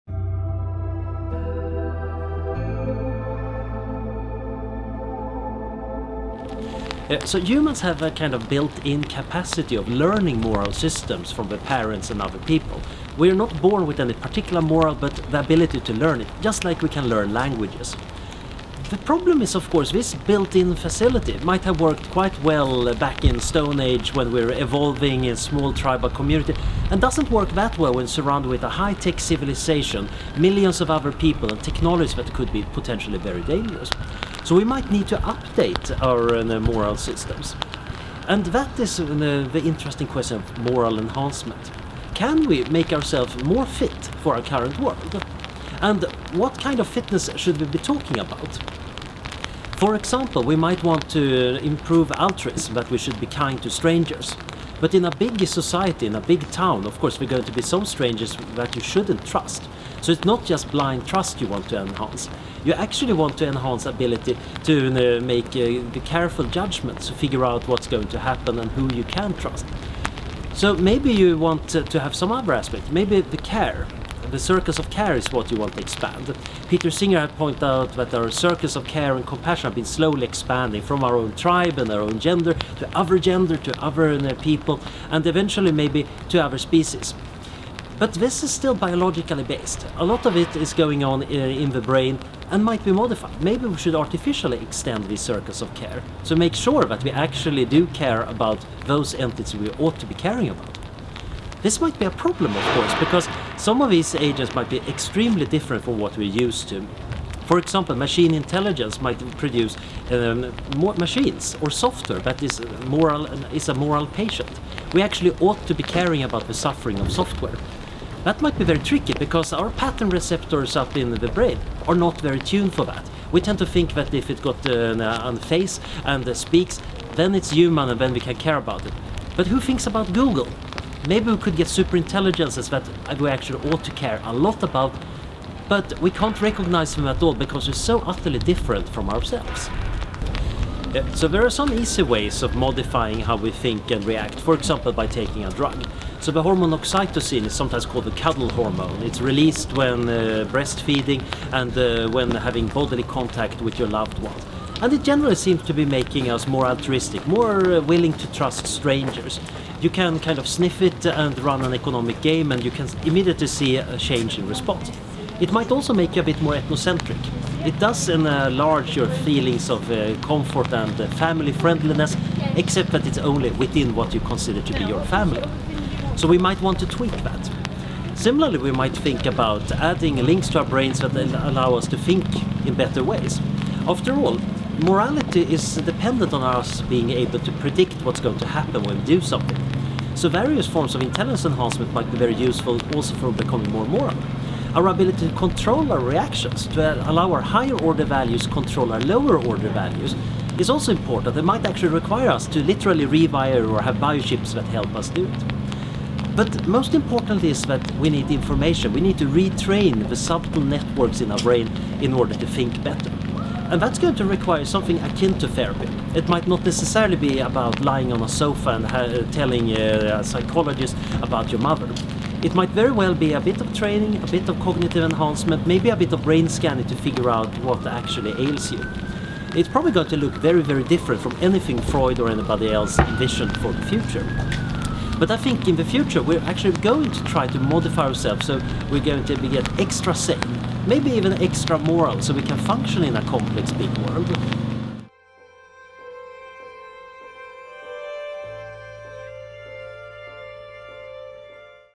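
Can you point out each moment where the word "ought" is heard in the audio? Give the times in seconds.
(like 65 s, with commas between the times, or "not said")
99 s, 115 s, 133 s.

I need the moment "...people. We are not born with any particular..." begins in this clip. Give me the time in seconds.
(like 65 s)
12 s.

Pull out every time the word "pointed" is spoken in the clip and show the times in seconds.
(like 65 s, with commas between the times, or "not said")
77 s.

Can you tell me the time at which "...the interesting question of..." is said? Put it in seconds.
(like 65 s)
39 s.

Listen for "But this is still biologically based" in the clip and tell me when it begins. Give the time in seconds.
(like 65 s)
88 s.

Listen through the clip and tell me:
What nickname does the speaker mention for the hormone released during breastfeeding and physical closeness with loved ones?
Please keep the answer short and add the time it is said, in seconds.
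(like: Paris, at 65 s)
cuddle hormone, at 148 s.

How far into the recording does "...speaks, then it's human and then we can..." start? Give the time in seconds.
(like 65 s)
126 s.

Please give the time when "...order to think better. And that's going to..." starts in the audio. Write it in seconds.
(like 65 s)
212 s.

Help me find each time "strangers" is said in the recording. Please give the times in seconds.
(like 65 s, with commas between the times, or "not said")
53 s, 57 s, 158 s.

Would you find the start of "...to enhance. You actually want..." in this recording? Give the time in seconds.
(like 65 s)
61 s.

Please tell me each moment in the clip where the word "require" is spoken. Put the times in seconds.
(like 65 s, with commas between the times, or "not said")
201 s, 214 s.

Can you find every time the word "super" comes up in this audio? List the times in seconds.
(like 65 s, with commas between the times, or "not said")
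131 s.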